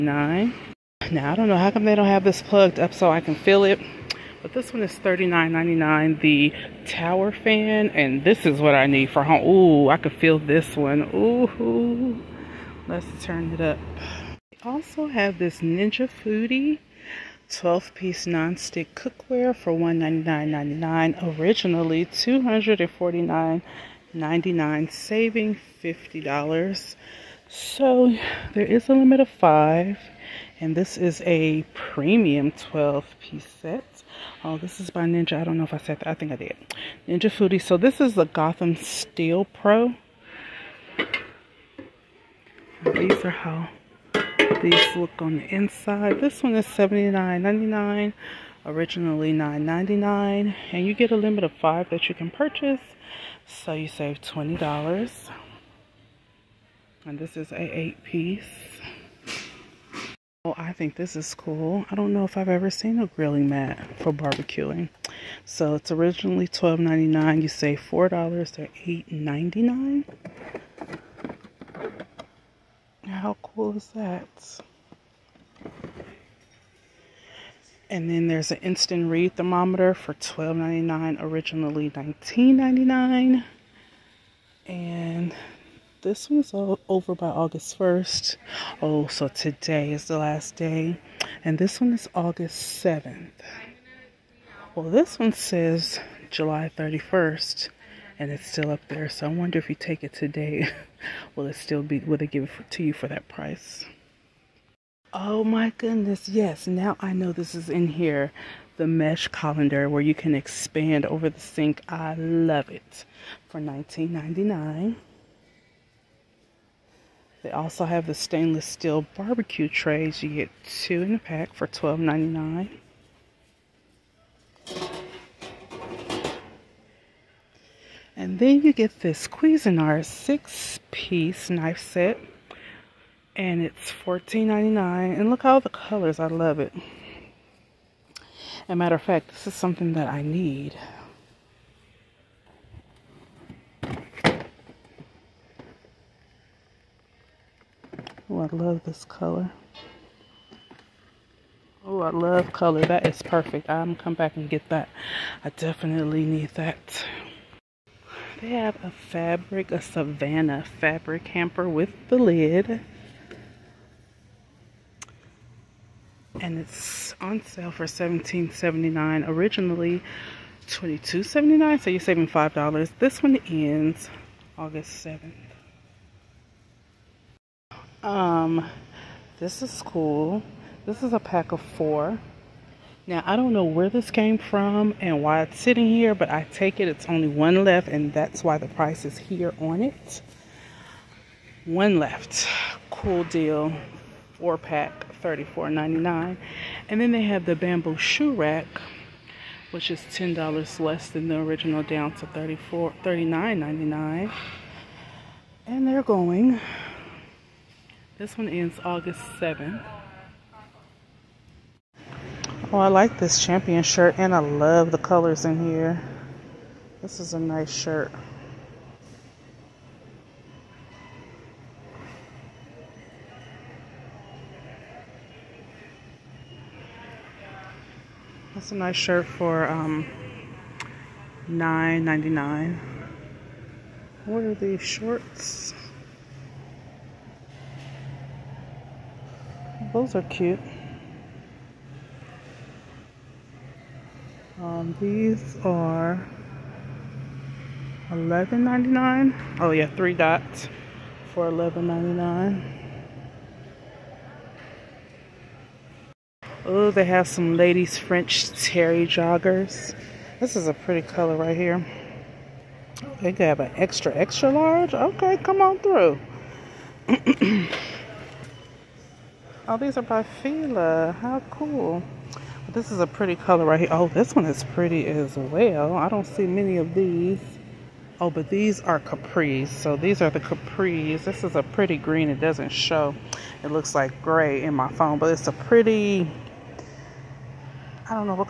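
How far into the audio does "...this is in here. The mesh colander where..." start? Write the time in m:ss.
1:47.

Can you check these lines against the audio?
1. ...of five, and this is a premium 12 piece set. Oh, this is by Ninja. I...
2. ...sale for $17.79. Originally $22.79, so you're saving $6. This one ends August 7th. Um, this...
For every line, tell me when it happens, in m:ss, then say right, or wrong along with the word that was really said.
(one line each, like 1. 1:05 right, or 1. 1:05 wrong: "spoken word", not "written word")
1. 0:29 right
2. 2:47 wrong: "5", not "6".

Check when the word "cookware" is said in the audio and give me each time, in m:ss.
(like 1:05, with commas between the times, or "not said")
0:18.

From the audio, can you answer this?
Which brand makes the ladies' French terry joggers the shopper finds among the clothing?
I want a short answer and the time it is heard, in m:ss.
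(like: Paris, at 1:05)
Fila, at 4:30.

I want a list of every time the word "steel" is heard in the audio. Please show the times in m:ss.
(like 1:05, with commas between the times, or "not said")
0:38, 1:58.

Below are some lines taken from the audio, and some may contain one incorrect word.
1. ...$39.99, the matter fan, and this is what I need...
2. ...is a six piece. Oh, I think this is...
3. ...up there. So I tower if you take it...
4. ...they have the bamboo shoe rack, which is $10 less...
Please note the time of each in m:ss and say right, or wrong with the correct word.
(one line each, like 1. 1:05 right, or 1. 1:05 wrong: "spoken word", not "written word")
1. 0:04 wrong: "tower", not "matter"
2. 0:57 wrong: "eight", not "six"
3. 1:38 wrong: "wonder", not "tower"
4. 3:17 right.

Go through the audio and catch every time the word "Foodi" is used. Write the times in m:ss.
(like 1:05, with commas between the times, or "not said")
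0:16, 0:37.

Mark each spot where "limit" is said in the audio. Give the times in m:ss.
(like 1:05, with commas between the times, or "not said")
0:28, 0:51.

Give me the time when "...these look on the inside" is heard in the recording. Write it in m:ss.
0:44.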